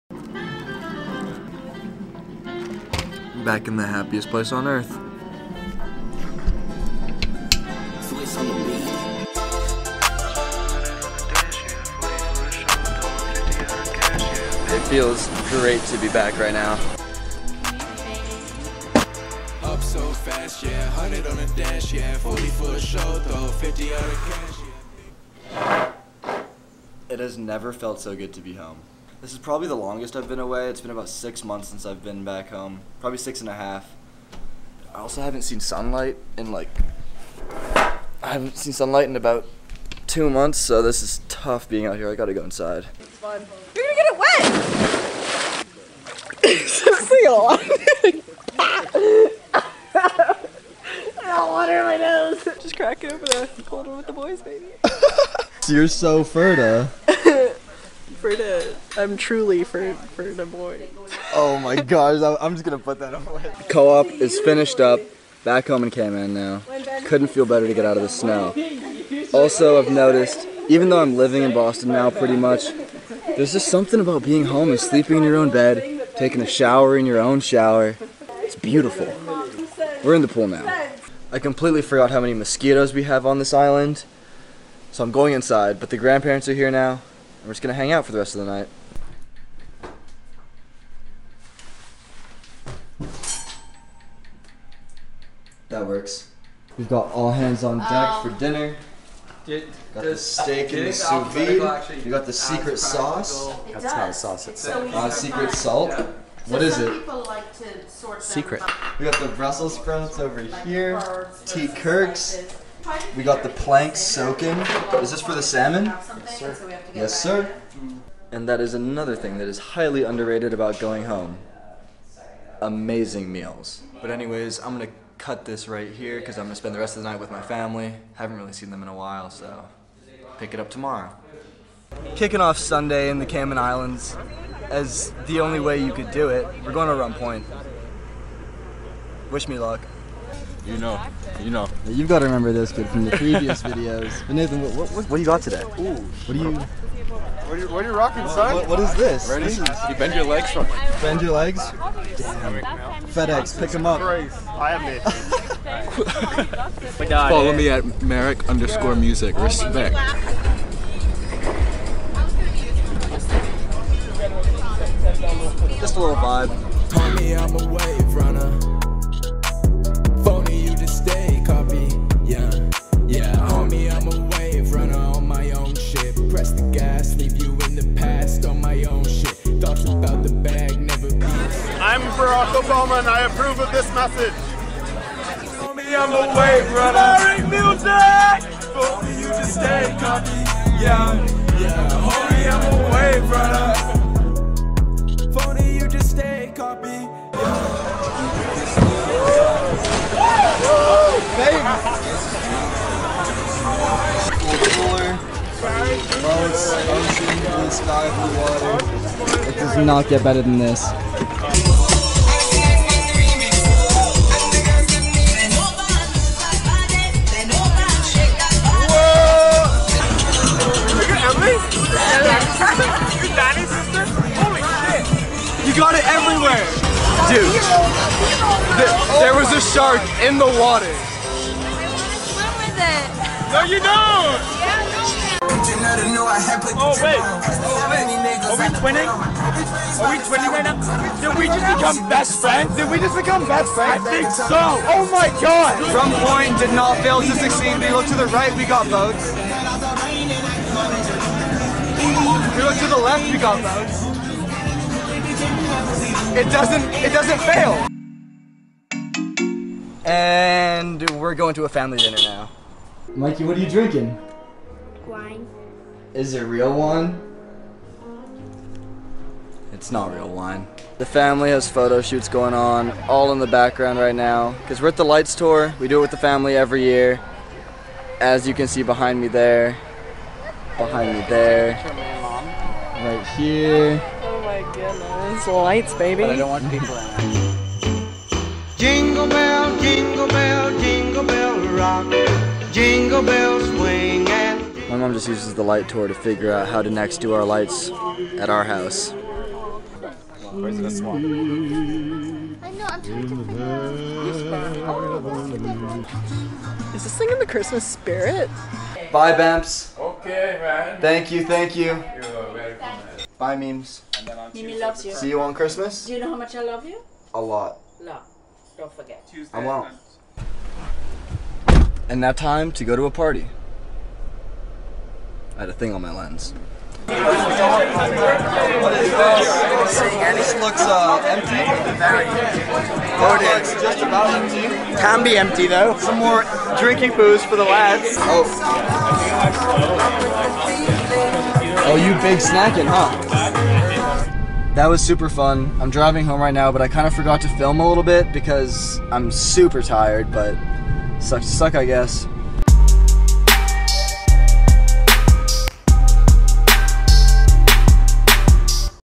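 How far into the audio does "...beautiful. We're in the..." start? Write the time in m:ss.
1:18.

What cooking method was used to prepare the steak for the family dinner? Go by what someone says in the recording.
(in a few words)
Sous vide.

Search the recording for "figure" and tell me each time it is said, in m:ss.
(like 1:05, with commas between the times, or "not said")
4:56, 5:03.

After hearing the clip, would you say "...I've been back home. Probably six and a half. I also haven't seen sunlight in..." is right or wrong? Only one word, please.
right.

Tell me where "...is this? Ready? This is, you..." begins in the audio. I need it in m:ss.
2:28.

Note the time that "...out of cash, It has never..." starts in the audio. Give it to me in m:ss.
0:23.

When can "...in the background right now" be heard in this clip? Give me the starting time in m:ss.
4:33.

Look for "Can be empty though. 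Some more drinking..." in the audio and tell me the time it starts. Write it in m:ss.
5:35.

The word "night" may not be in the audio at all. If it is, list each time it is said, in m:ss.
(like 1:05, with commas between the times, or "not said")
1:28, 2:07.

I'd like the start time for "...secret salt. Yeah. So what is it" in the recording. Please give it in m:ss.
1:45.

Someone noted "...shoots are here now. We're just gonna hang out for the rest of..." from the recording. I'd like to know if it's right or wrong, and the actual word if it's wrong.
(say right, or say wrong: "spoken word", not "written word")
wrong: "grandparents", not "shoots".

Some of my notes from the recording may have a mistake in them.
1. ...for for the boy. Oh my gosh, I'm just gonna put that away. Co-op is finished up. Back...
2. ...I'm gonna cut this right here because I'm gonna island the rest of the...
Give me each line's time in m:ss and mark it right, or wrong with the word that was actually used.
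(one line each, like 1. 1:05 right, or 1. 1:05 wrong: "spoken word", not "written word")
1. 0:59 right
2. 2:04 wrong: "spend", not "island".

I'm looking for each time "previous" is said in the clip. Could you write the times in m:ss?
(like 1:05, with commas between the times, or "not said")
2:23.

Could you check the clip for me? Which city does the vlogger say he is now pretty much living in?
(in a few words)
Boston.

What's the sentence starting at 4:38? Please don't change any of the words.
As you can see behind me there.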